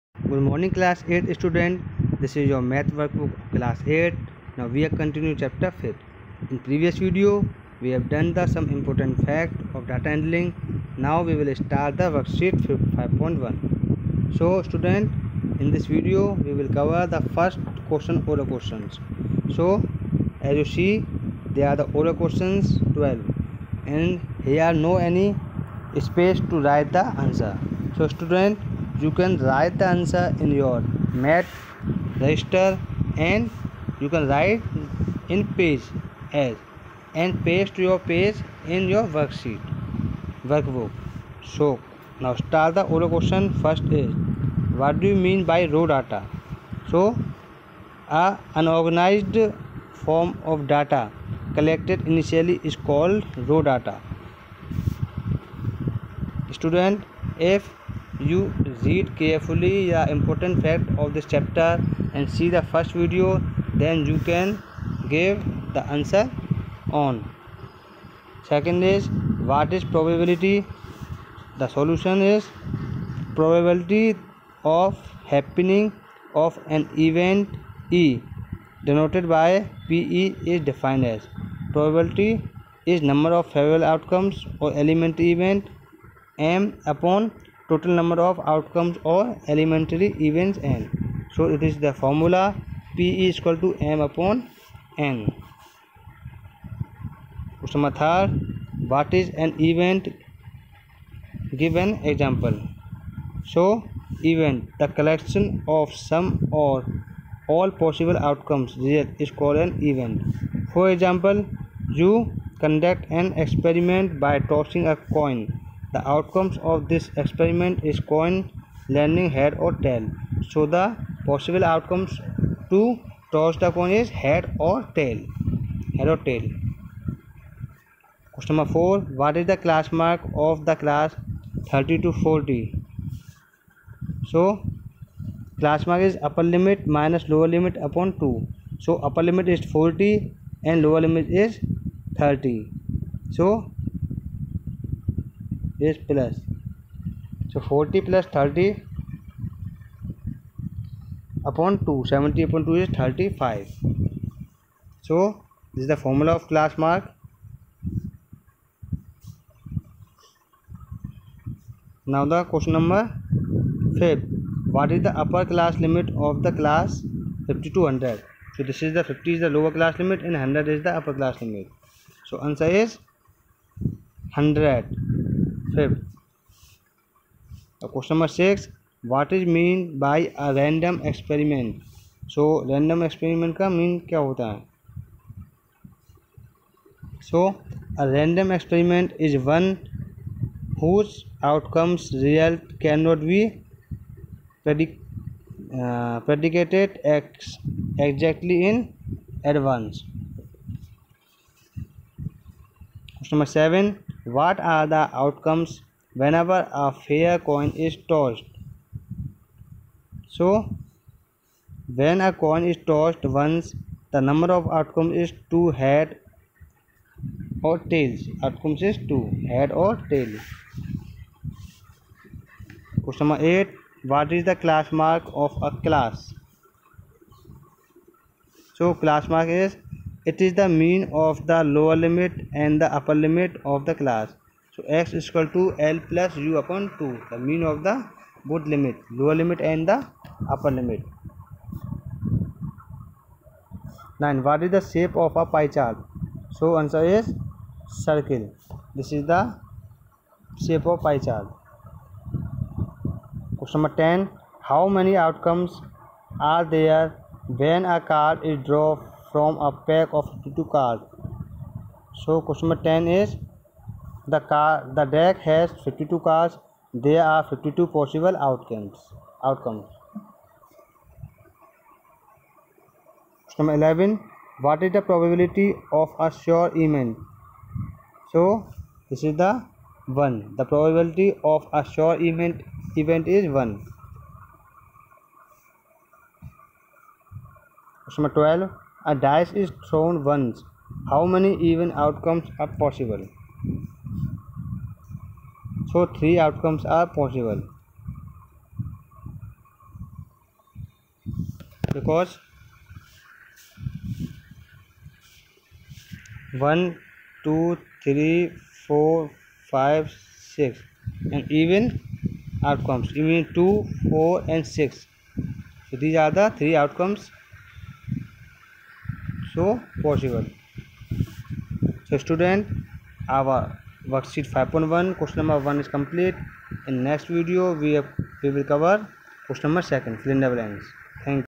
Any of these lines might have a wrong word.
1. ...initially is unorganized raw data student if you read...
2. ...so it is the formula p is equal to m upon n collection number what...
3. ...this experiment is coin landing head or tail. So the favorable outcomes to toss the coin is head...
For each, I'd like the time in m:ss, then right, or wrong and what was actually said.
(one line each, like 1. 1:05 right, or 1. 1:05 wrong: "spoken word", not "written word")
1. 0:52 wrong: "called", not "unorganized"
2. 1:31 wrong: "question", not "collection"
3. 1:56 wrong: "possible", not "favorable".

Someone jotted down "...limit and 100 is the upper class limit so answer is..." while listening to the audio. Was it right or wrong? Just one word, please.
right.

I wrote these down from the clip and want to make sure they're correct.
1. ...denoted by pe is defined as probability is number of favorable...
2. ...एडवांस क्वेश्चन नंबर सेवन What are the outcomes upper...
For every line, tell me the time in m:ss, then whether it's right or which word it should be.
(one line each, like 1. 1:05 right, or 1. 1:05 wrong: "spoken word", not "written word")
1. 1:18 right
2. 3:19 wrong: "whenever", not "upper".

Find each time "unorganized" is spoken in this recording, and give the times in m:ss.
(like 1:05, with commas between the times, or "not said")
0:48.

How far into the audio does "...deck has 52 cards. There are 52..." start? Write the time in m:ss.
4:25.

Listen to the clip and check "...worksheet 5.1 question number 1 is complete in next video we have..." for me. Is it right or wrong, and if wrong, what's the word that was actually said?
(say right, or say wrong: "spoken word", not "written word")
right.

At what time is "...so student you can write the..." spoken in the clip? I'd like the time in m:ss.
0:27.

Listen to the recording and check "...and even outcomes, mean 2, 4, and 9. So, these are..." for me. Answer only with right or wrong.
wrong.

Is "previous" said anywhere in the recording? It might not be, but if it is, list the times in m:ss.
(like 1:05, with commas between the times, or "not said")
0:06.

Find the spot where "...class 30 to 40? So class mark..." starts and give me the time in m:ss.
2:10.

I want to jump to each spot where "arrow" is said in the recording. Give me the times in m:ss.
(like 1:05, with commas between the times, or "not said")
not said.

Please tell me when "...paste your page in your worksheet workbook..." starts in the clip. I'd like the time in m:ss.
0:37.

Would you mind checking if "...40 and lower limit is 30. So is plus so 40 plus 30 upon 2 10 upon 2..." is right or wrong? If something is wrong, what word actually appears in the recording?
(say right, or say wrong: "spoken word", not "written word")
wrong: "70", not "10".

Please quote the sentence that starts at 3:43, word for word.
Question number 8 What is the class mark of a class?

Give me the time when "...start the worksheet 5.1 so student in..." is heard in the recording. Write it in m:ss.
0:11.